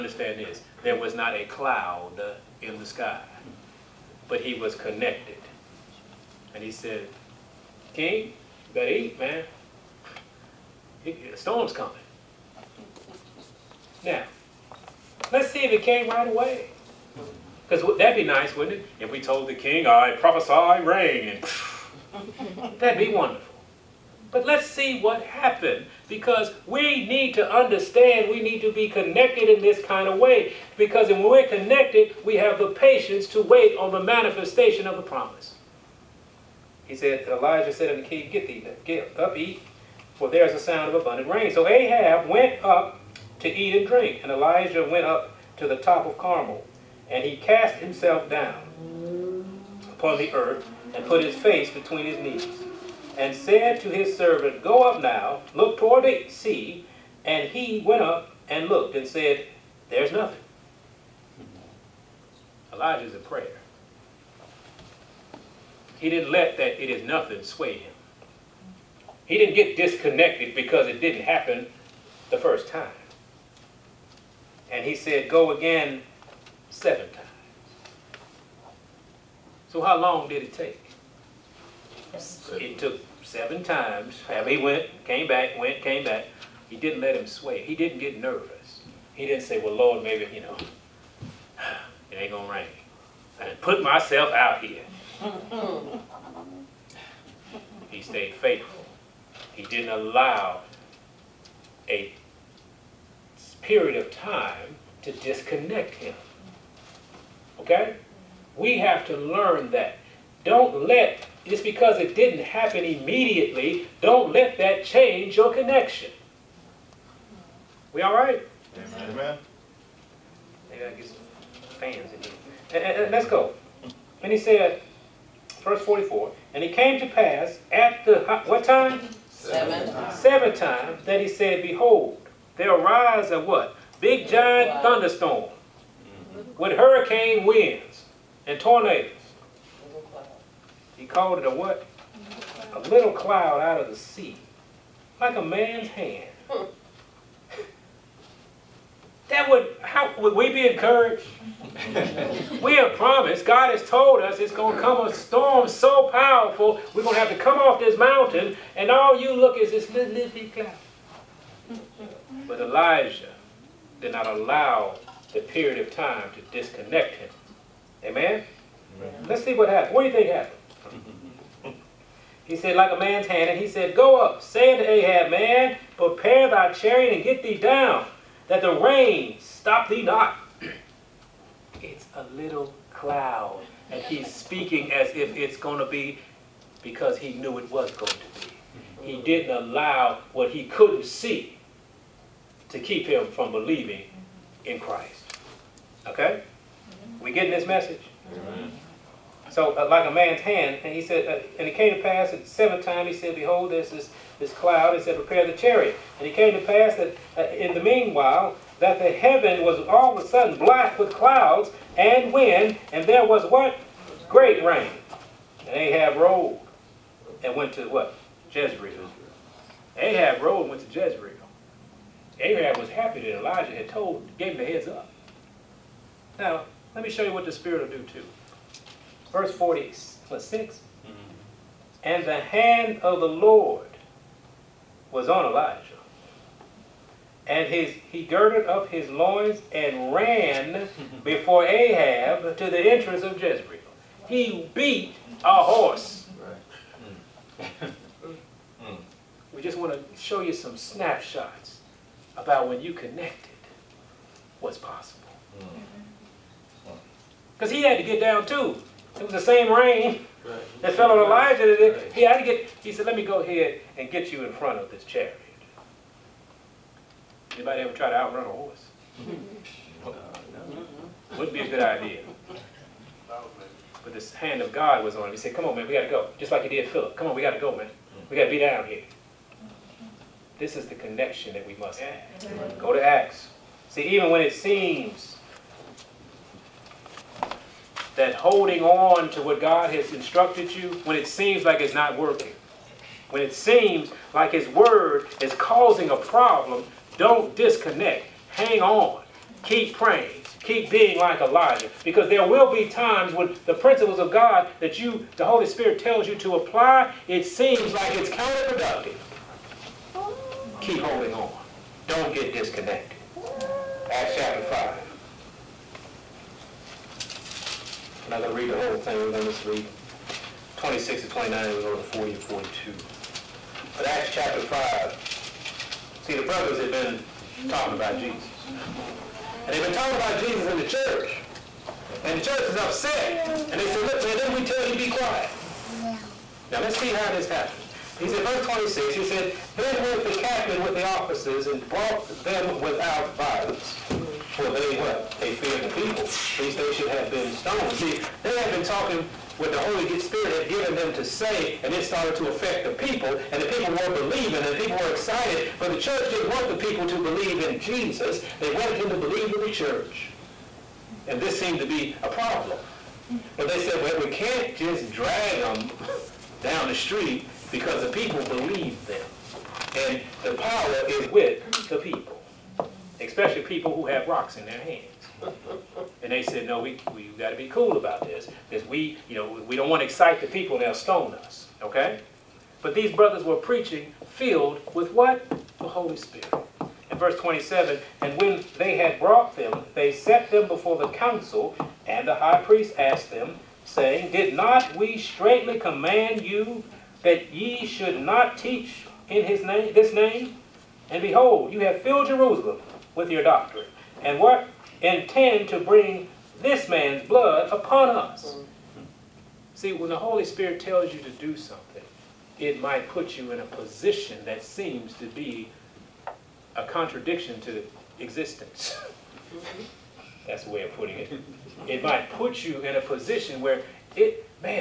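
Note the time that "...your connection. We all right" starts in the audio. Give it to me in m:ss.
1:55.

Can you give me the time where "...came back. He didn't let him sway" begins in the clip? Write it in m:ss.
1:25.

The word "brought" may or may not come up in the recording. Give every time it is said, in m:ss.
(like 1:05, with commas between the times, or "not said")
5:41, 6:29.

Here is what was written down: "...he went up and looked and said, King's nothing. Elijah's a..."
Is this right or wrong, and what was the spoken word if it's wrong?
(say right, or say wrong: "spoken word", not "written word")
wrong: "There", not "King".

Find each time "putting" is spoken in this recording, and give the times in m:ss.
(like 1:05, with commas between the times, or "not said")
7:00.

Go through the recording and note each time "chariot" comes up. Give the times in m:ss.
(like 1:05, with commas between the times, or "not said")
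2:56, 3:25, 4:25.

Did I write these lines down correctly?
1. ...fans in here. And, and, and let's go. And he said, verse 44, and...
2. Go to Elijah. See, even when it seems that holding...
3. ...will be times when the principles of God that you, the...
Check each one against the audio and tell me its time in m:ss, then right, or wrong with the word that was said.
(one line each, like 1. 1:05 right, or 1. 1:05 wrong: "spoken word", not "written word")
1. 2:01 right
2. 4:42 wrong: "Acts", not "Elijah"
3. 5:02 right.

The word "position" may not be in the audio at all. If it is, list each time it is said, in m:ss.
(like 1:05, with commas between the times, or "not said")
6:53, 7:03.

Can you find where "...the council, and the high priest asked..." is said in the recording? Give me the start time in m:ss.
6:30.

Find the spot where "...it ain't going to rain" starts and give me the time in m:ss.
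1:32.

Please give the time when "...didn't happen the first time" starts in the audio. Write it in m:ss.
1:11.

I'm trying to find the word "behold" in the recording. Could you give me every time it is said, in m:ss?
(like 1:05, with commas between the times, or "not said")
2:11, 3:23, 6:41.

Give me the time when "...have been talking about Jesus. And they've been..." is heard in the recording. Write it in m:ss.
5:26.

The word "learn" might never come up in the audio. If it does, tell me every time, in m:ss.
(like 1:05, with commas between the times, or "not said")
1:49.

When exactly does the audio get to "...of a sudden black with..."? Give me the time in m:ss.
3:30.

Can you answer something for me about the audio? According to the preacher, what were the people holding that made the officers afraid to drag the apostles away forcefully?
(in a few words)
rocks.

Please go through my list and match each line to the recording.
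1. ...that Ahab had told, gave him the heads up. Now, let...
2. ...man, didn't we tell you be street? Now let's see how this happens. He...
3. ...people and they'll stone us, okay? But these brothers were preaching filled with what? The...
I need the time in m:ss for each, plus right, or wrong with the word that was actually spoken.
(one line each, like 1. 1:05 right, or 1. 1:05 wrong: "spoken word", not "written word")
1. 3:43 wrong: "Elijah", not "Ahab"
2. 5:34 wrong: "quiet", not "street"
3. 6:20 right.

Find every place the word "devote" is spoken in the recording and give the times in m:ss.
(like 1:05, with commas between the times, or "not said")
not said.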